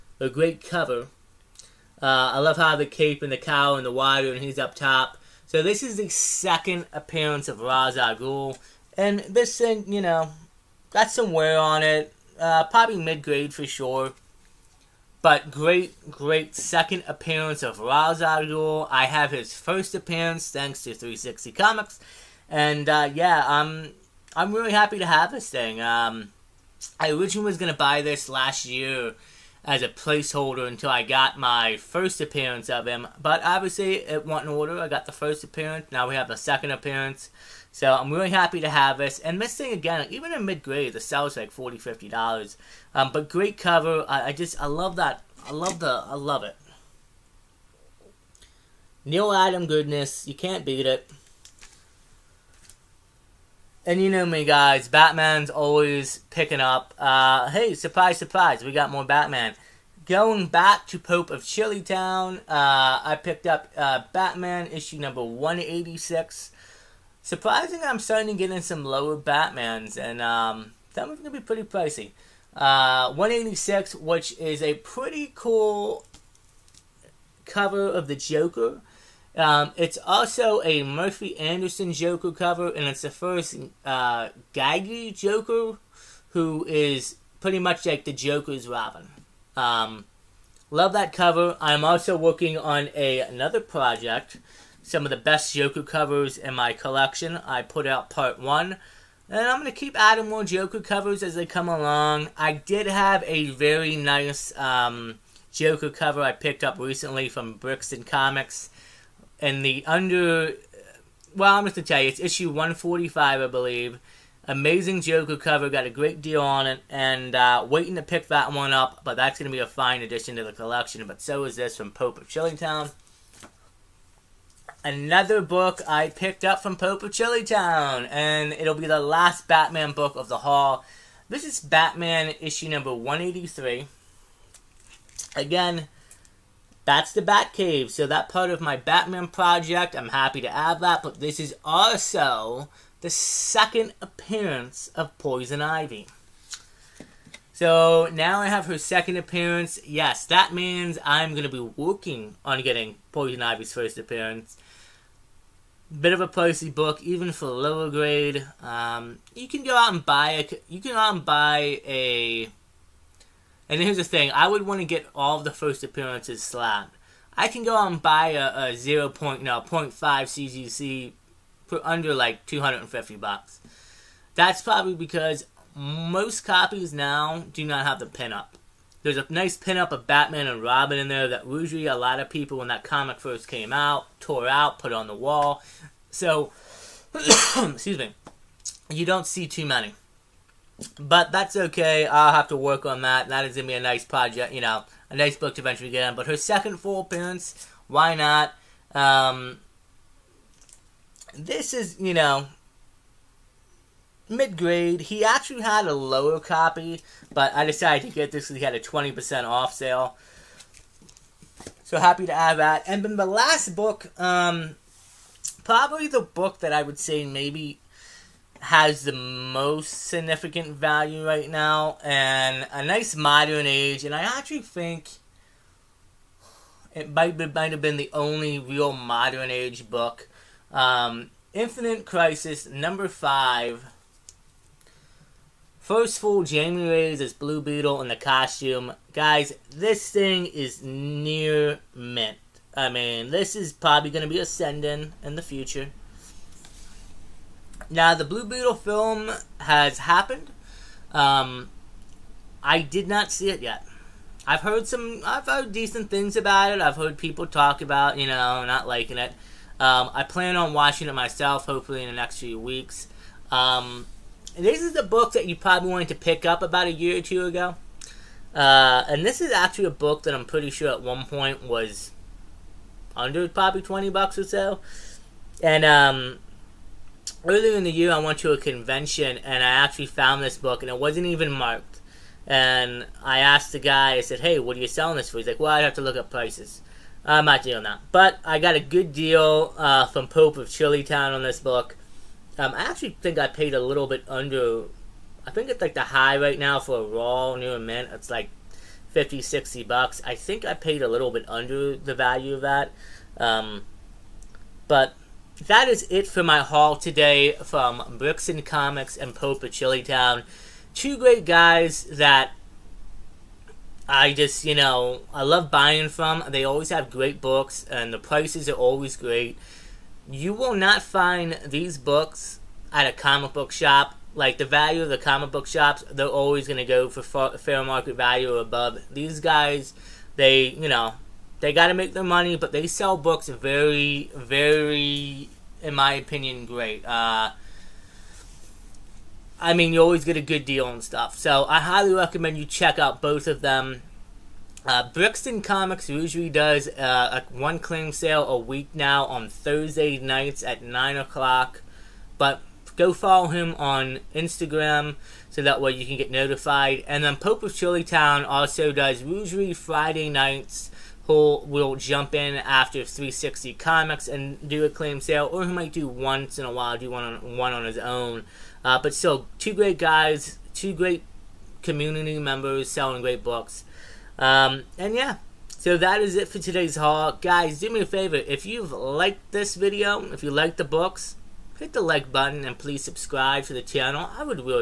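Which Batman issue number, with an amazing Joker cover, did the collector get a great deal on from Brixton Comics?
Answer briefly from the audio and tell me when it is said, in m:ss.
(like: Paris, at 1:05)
145, at 1:52.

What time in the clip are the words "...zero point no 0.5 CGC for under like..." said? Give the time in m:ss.
2:48.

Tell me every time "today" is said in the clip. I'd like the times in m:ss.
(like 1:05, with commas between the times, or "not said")
5:06, 6:16.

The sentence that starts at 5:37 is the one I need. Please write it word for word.
Uh, I mean, you always get a good deal and stuff.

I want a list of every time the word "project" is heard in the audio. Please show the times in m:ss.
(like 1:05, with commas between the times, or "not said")
1:33, 2:19, 3:14.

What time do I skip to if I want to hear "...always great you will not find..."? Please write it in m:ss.
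5:18.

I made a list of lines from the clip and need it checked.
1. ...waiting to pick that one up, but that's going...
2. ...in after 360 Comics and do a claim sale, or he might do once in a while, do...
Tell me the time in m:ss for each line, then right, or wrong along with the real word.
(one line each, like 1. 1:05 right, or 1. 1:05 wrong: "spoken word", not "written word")
1. 1:57 right
2. 6:02 right.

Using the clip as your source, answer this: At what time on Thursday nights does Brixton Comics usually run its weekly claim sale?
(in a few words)
9 o'clock.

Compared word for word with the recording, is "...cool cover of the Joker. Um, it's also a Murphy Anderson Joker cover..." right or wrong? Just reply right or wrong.
right.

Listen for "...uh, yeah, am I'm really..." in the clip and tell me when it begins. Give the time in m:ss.
0:22.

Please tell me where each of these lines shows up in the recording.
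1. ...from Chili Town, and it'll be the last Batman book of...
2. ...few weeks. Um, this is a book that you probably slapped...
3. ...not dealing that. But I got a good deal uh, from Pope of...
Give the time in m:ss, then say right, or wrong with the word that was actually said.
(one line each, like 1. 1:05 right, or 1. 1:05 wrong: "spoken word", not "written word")
1. 2:06 right
2. 4:22 wrong: "wanted", not "slapped"
3. 4:47 right.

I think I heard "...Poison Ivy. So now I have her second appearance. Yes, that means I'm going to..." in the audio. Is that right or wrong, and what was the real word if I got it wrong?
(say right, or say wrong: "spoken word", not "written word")
right.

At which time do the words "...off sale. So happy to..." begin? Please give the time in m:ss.
3:29.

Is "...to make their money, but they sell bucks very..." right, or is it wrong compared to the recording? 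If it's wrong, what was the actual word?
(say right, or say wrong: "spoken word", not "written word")
wrong: "books", not "bucks".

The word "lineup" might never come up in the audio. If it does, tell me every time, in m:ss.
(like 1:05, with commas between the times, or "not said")
not said.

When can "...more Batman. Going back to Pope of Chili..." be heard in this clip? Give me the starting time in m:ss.
0:58.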